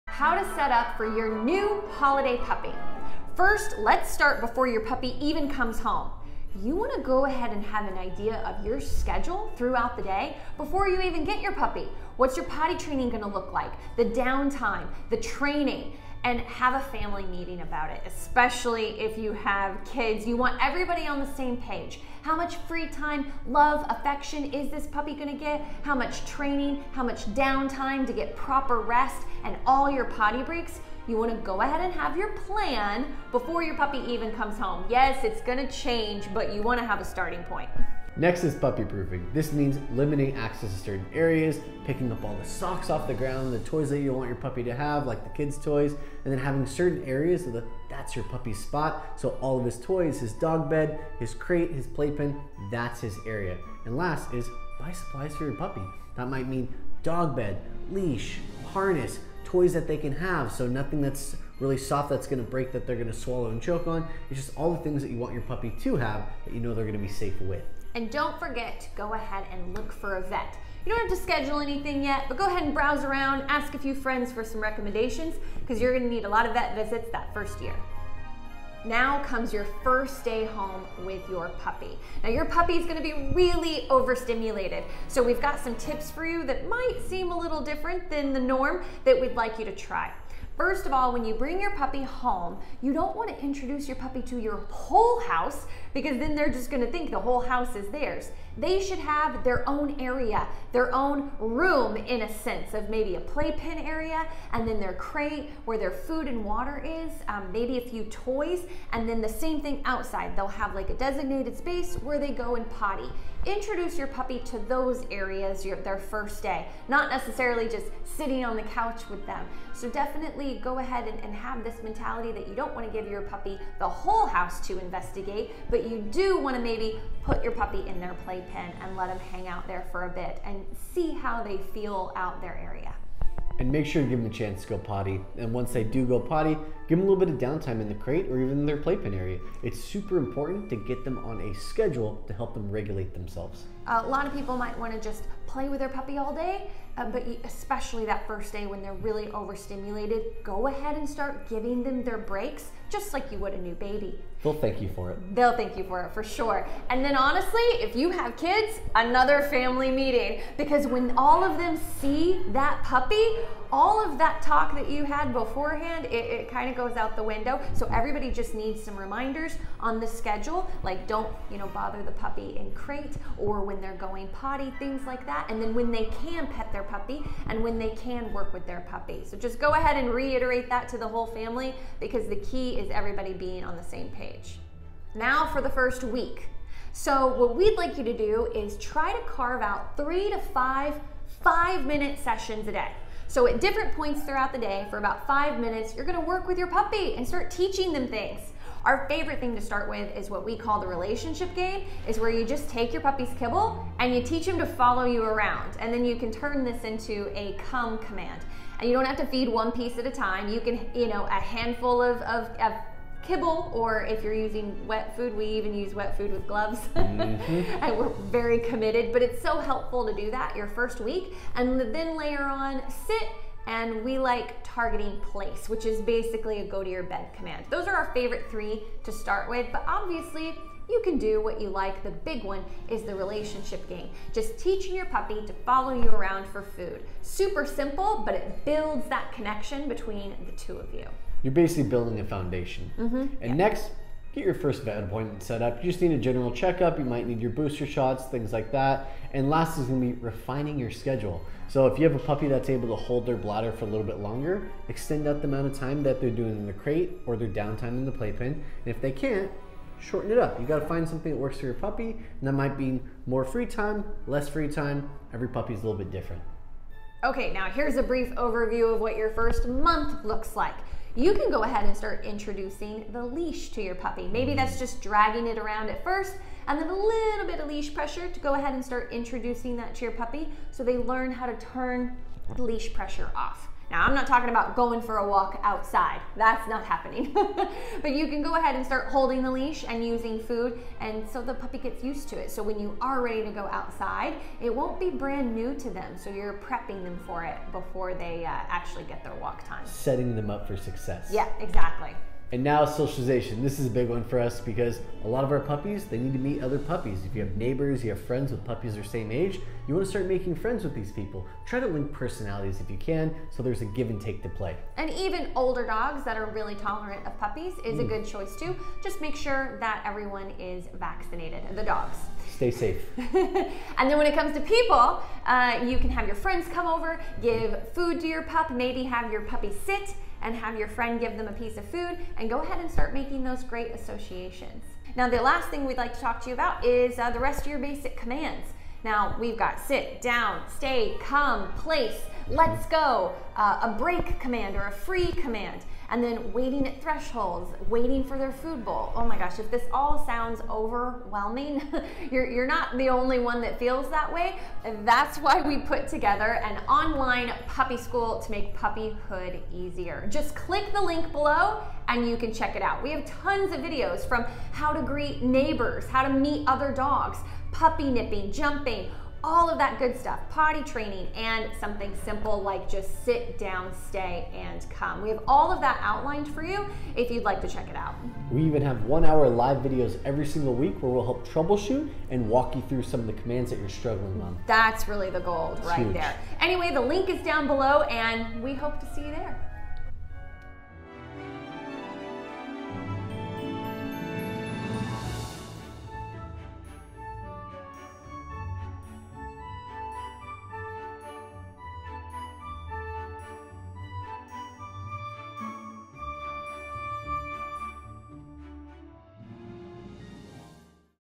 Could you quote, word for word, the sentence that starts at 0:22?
How much free time, love, affection is this puppy going to get?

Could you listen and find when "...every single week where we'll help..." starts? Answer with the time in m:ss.
6:20.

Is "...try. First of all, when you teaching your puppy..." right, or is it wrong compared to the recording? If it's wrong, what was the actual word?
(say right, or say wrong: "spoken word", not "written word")
wrong: "bring", not "teaching".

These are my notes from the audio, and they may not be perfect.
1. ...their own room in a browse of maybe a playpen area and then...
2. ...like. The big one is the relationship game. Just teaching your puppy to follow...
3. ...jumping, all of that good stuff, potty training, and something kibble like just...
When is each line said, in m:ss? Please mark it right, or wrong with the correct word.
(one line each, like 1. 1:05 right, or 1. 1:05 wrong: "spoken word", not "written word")
1. 1:40 wrong: "sense", not "browse"
2. 3:51 right
3. 6:08 wrong: "simple", not "kibble".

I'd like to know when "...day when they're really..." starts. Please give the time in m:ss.
2:28.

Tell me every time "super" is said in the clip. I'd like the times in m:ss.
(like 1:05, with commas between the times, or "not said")
2:19, 3:57.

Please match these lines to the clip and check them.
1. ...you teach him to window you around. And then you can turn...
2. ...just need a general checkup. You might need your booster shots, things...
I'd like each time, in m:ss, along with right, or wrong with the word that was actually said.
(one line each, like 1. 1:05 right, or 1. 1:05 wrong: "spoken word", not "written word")
1. 3:24 wrong: "follow", not "window"
2. 4:05 right.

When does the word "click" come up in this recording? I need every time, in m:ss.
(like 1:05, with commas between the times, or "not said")
6:00.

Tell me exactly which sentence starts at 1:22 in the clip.
Now, your puppy is gonna be really overstimulated.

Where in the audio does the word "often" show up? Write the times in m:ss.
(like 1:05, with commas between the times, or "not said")
not said.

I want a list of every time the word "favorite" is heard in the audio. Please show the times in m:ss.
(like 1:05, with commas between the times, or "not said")
3:19, 3:48.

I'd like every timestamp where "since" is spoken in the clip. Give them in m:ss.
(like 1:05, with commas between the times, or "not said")
not said.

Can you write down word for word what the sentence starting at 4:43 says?
Now, I'm not talking about going for a walk outside.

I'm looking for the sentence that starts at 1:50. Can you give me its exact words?
They'll have like a designated space where they go and potty.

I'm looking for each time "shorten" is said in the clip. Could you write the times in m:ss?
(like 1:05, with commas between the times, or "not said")
4:19.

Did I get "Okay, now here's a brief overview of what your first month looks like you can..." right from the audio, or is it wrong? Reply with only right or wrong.
right.